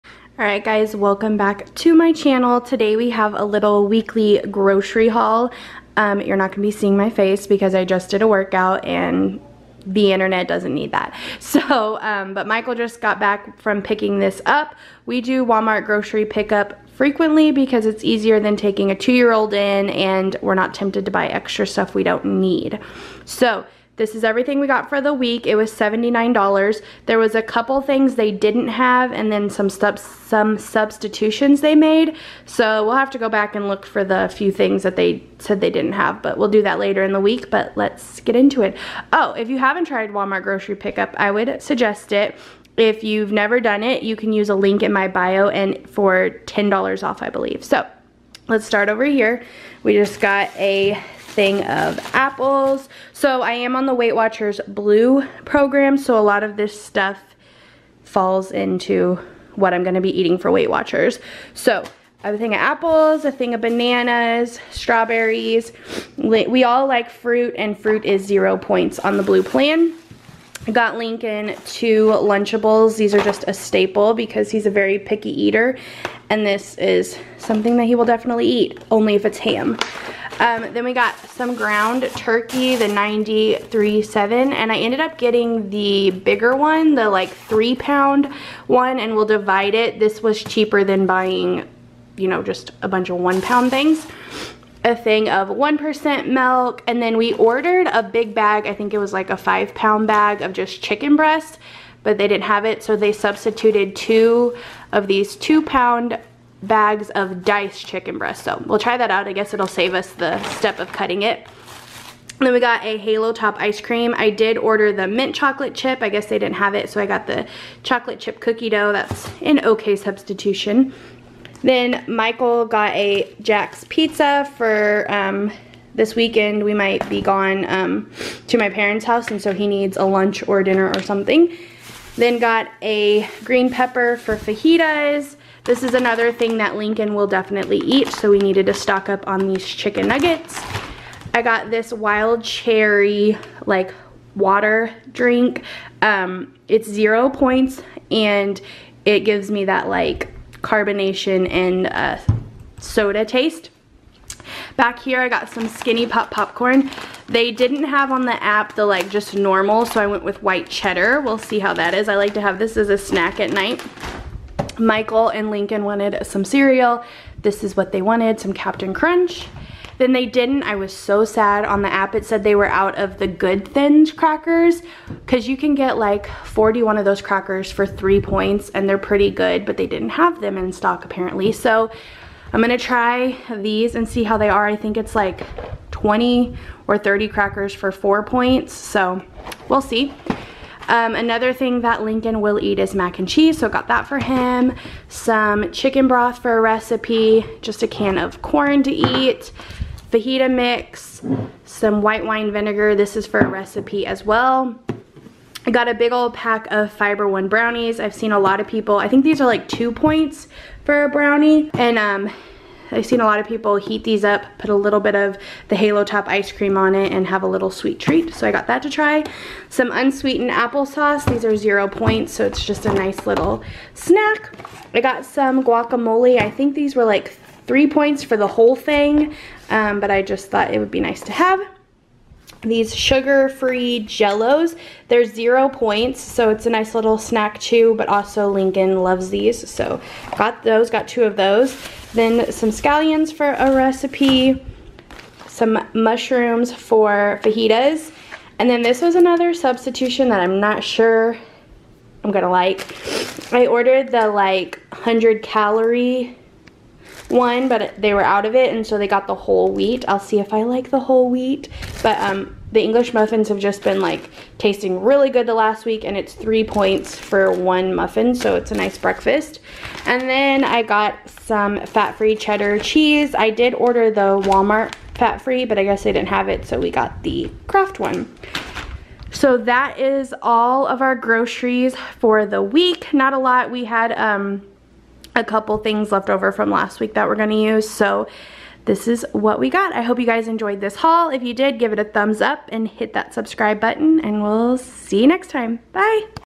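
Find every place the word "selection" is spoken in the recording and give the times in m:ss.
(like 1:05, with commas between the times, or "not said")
not said.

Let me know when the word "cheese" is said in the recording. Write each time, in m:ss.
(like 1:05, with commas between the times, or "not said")
3:13, 4:32.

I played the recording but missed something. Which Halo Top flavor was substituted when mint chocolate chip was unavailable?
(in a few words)
chocolate chip cookie dough.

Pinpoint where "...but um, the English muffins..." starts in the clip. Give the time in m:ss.
4:22.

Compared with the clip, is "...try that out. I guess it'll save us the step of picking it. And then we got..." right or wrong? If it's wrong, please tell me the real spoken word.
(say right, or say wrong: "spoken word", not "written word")
wrong: "cutting", not "picking".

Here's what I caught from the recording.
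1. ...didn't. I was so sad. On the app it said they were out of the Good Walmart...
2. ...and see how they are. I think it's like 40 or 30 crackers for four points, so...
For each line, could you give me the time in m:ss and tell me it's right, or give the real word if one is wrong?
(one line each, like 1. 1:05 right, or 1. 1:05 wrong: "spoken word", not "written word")
1. 2:50 wrong: "Thins", not "Walmart"
2. 3:03 wrong: "20", not "40".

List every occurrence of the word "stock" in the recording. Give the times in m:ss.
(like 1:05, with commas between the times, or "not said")
2:18, 3:00.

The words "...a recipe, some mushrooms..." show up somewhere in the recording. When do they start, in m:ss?
4:03.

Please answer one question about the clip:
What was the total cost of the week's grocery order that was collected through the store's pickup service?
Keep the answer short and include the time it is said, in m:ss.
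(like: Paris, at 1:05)
$79, at 0:25.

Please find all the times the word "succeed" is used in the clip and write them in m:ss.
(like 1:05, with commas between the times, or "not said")
not said.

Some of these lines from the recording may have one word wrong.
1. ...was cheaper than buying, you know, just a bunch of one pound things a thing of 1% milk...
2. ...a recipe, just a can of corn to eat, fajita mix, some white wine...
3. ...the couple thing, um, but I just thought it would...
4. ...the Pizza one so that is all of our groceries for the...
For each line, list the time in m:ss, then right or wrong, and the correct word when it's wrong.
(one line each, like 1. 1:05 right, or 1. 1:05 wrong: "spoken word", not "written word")
1. 1:30 right
2. 3:16 right
3. 3:48 wrong: "whole", not "couple"
4. 4:37 wrong: "Kraft", not "Pizza".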